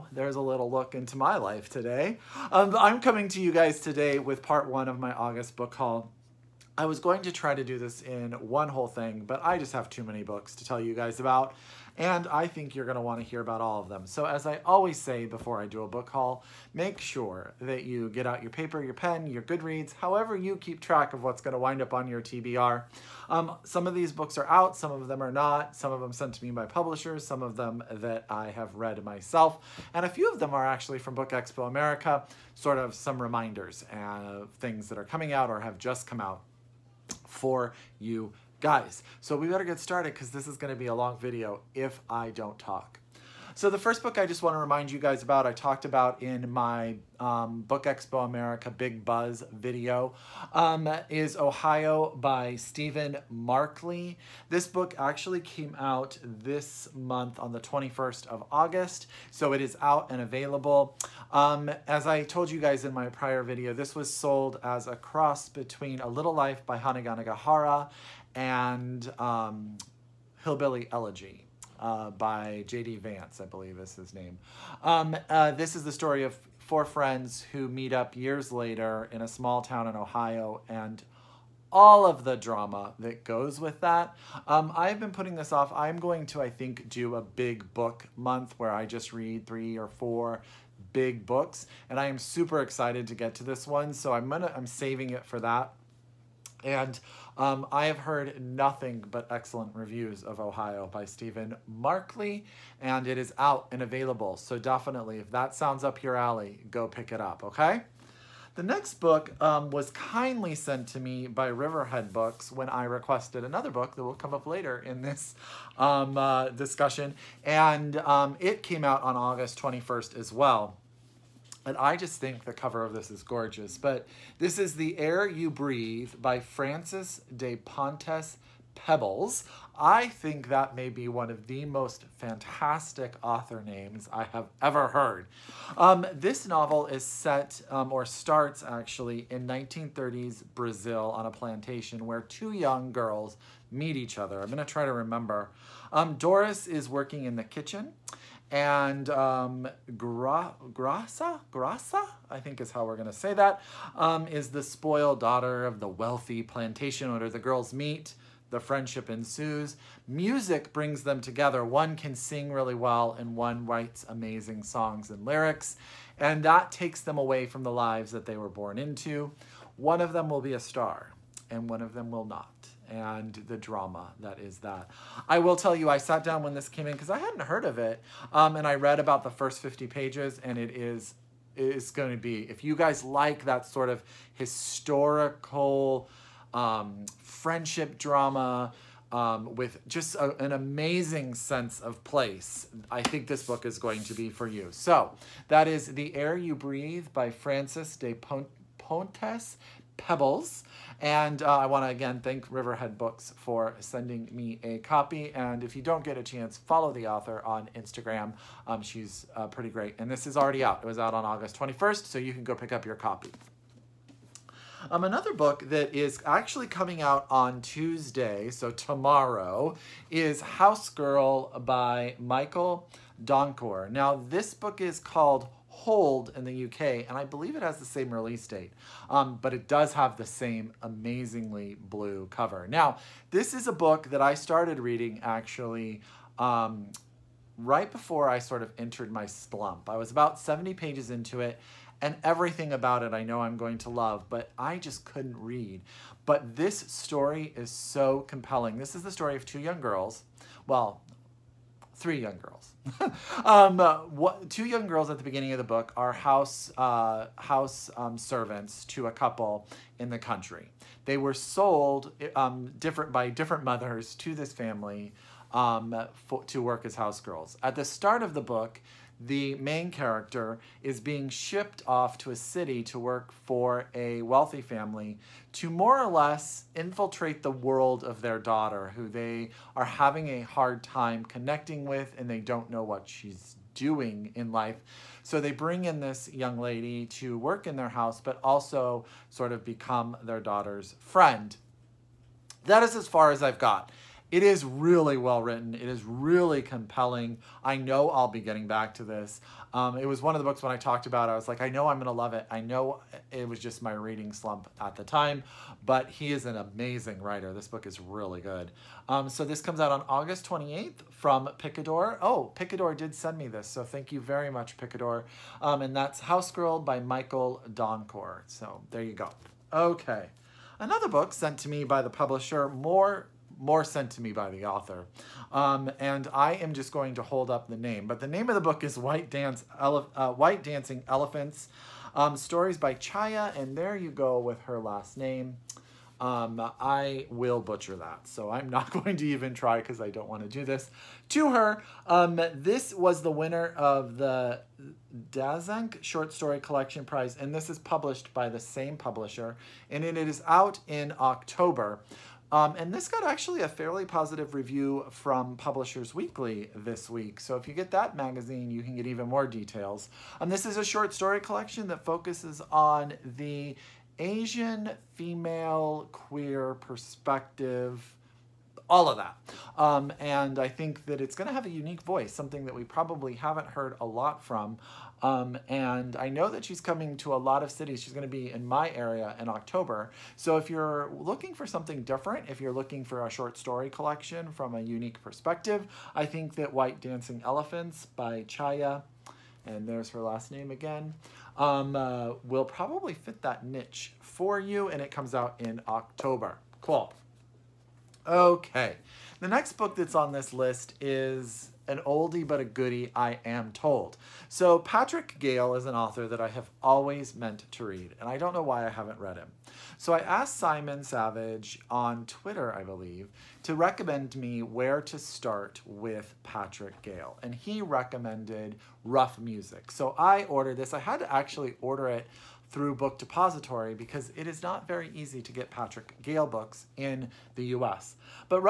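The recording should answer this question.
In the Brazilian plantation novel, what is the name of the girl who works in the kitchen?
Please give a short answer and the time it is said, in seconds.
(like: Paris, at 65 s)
Doris, at 146 s.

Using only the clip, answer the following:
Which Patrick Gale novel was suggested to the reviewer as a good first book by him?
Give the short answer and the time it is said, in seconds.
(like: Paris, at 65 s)
Rough Music, at 419 s.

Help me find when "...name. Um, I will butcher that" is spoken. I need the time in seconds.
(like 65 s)
335 s.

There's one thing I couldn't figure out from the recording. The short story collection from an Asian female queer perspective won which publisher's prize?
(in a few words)
Dzanc.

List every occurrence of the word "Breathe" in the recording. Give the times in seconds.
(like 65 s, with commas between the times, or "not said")
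125 s, 196 s.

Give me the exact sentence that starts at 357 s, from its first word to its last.
So if you get that magazine, you can get even more details.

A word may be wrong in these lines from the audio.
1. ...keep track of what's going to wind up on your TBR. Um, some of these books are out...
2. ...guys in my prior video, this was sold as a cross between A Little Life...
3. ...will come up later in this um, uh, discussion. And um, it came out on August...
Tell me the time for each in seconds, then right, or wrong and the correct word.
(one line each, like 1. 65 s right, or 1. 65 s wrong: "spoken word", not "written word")
1. 20 s right
2. 62 s right
3. 114 s right.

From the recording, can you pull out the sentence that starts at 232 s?
Now, this is a book that I started reading actually um, right before I sort of entered my slump.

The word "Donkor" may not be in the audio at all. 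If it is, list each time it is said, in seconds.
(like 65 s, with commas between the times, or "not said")
223 s, 317 s.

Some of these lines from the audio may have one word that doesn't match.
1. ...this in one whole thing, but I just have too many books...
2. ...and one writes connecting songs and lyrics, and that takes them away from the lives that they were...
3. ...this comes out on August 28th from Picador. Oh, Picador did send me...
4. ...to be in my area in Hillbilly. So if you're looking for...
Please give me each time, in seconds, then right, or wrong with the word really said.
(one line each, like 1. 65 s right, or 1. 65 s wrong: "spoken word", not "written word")
1. 7 s right
2. 163 s wrong: "amazing", not "connecting"
3. 309 s right
4. 378 s wrong: "October", not "Hillbilly".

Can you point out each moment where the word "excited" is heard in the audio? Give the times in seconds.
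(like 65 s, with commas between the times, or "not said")
92 s.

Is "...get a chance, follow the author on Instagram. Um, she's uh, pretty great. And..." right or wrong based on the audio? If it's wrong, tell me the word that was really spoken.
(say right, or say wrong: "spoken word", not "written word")
right.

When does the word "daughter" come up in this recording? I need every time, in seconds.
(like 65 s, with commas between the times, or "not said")
155 s, 278 s, 290 s.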